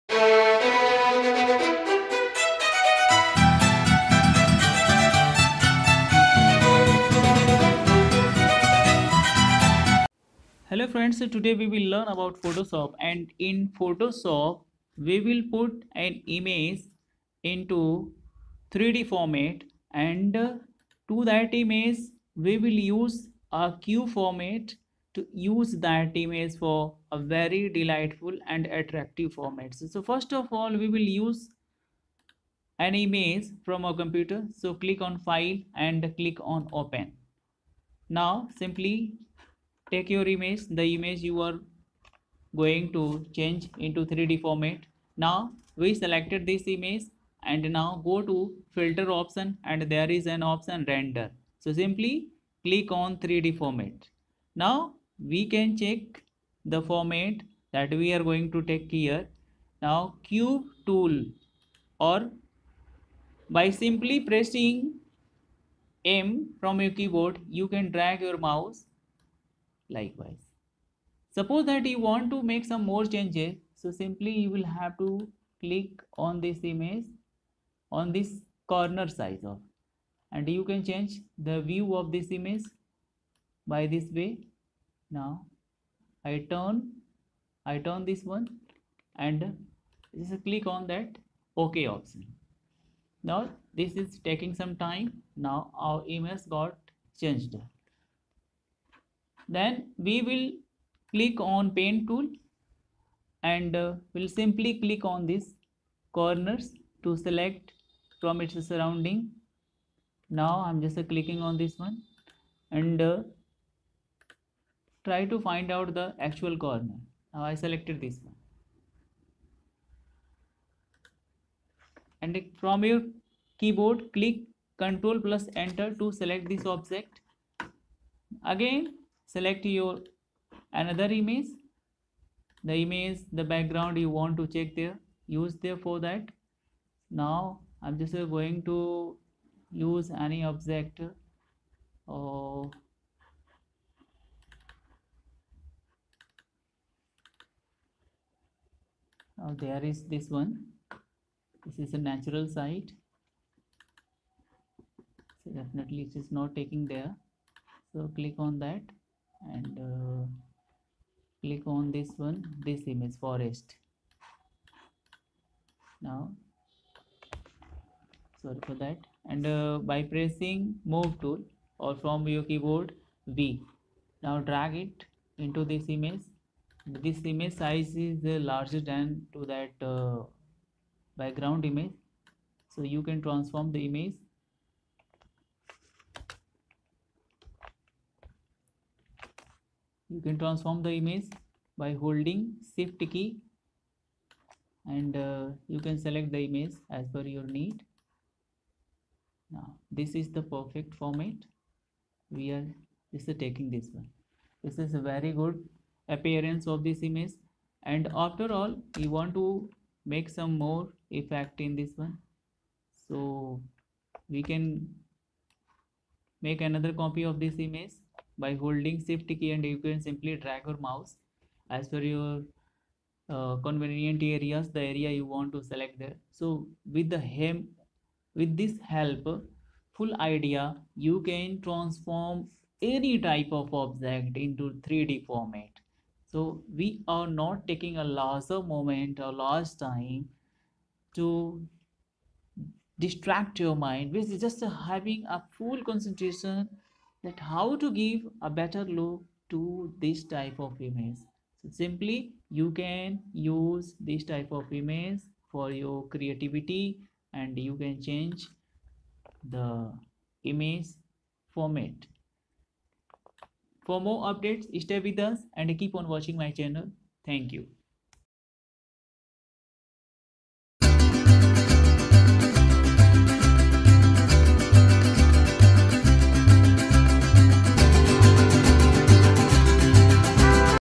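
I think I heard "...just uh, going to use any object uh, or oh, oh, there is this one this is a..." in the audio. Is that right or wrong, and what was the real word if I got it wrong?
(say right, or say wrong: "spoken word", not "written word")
right.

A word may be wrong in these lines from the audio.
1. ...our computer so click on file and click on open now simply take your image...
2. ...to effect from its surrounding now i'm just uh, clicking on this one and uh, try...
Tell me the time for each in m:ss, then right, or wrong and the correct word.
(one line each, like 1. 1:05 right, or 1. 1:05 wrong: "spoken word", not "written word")
1. 0:33 right
2. 1:47 wrong: "select", not "effect".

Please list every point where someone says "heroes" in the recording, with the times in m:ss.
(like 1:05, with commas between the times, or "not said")
not said.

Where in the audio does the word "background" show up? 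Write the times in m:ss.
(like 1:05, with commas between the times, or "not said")
2:13, 3:01.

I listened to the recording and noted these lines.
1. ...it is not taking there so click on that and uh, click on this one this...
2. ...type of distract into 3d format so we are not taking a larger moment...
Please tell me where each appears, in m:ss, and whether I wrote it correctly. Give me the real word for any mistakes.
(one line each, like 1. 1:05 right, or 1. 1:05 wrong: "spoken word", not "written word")
1. 2:36 right
2. 3:53 wrong: "object", not "distract".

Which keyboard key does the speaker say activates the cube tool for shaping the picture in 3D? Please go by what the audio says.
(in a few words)
M.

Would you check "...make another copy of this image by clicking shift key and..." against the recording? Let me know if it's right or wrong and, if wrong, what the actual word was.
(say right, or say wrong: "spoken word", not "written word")
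wrong: "holding", not "clicking".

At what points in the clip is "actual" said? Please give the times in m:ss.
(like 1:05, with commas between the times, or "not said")
1:56.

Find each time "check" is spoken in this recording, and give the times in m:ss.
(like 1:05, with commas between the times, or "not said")
0:55, 2:14.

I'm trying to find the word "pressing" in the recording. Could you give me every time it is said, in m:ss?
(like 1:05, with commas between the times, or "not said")
1:04, 2:50.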